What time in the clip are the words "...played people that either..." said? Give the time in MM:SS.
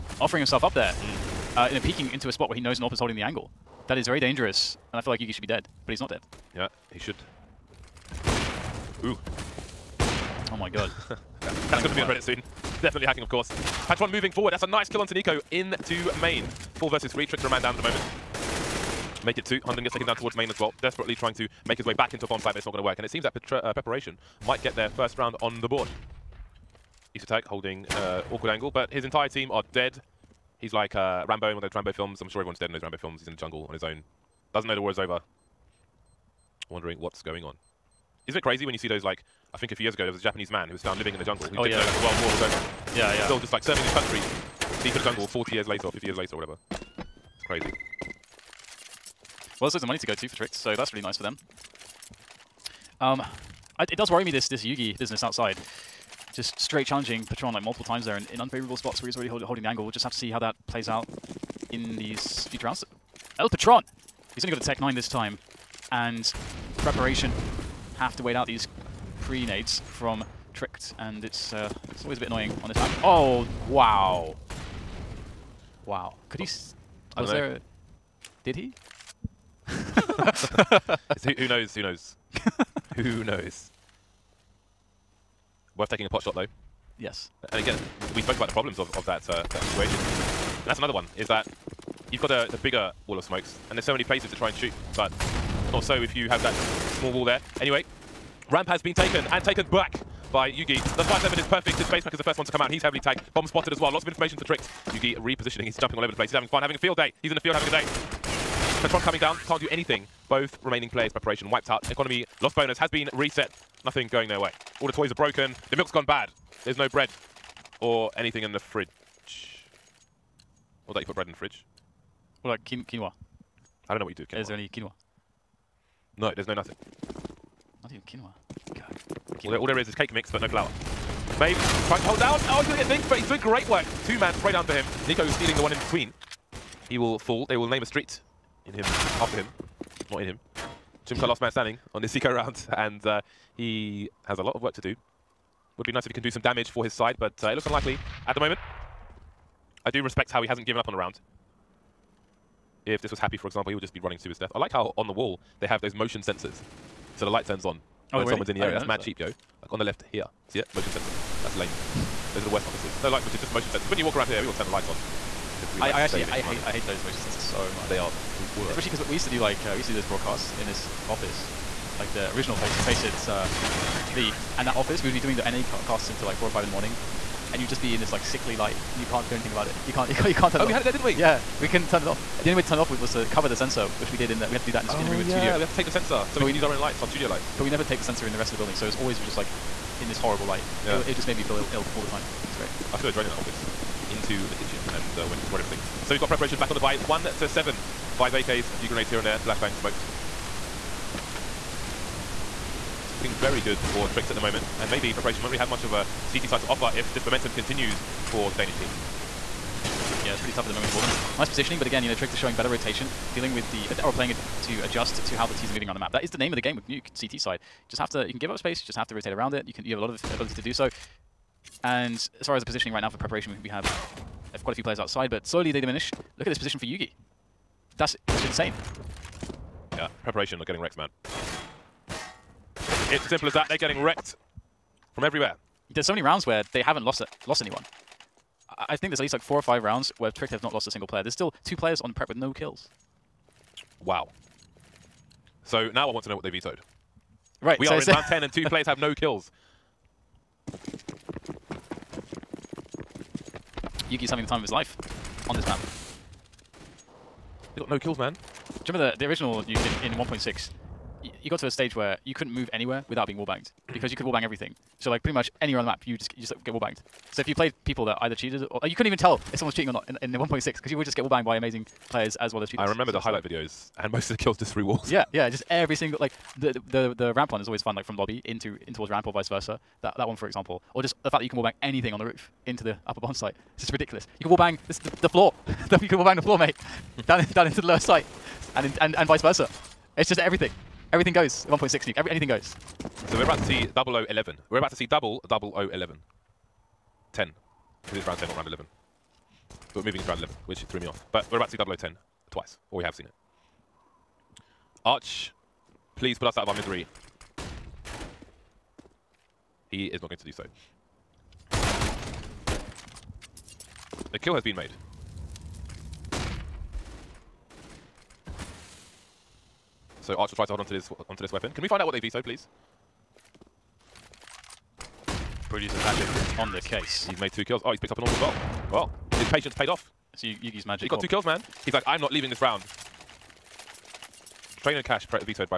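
04:27.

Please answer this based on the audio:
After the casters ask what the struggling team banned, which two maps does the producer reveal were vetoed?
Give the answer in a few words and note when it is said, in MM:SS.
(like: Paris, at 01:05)
Train and Cash, at 05:34.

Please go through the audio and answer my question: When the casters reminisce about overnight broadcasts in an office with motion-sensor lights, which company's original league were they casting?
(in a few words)
Faceit.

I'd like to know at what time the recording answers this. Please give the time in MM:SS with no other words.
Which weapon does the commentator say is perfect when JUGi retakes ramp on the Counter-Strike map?
01:41.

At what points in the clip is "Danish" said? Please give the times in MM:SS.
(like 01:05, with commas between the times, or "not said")
03:28.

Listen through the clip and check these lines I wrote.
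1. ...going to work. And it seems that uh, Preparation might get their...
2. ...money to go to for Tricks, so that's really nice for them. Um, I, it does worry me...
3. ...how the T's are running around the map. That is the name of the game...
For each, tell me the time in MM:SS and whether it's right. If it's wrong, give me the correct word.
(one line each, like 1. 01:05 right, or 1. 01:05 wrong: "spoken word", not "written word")
1. 00:22 right
2. 00:49 right
3. 03:35 wrong: "moving", not "running".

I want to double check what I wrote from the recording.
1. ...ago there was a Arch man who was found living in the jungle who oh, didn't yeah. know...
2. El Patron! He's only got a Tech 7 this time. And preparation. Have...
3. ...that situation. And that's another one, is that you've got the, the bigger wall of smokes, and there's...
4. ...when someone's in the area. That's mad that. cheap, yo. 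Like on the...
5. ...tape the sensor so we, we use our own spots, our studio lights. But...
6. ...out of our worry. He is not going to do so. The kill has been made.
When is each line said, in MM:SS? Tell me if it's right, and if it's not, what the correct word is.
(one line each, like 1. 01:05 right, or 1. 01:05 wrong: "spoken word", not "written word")
1. 00:39 wrong: "Japanese", not "Arch"
2. 01:03 wrong: "9", not "7"
3. 01:29 right
4. 02:38 right
5. 03:05 wrong: "lights", not "spots"
6. 05:06 wrong: "misery", not "worry".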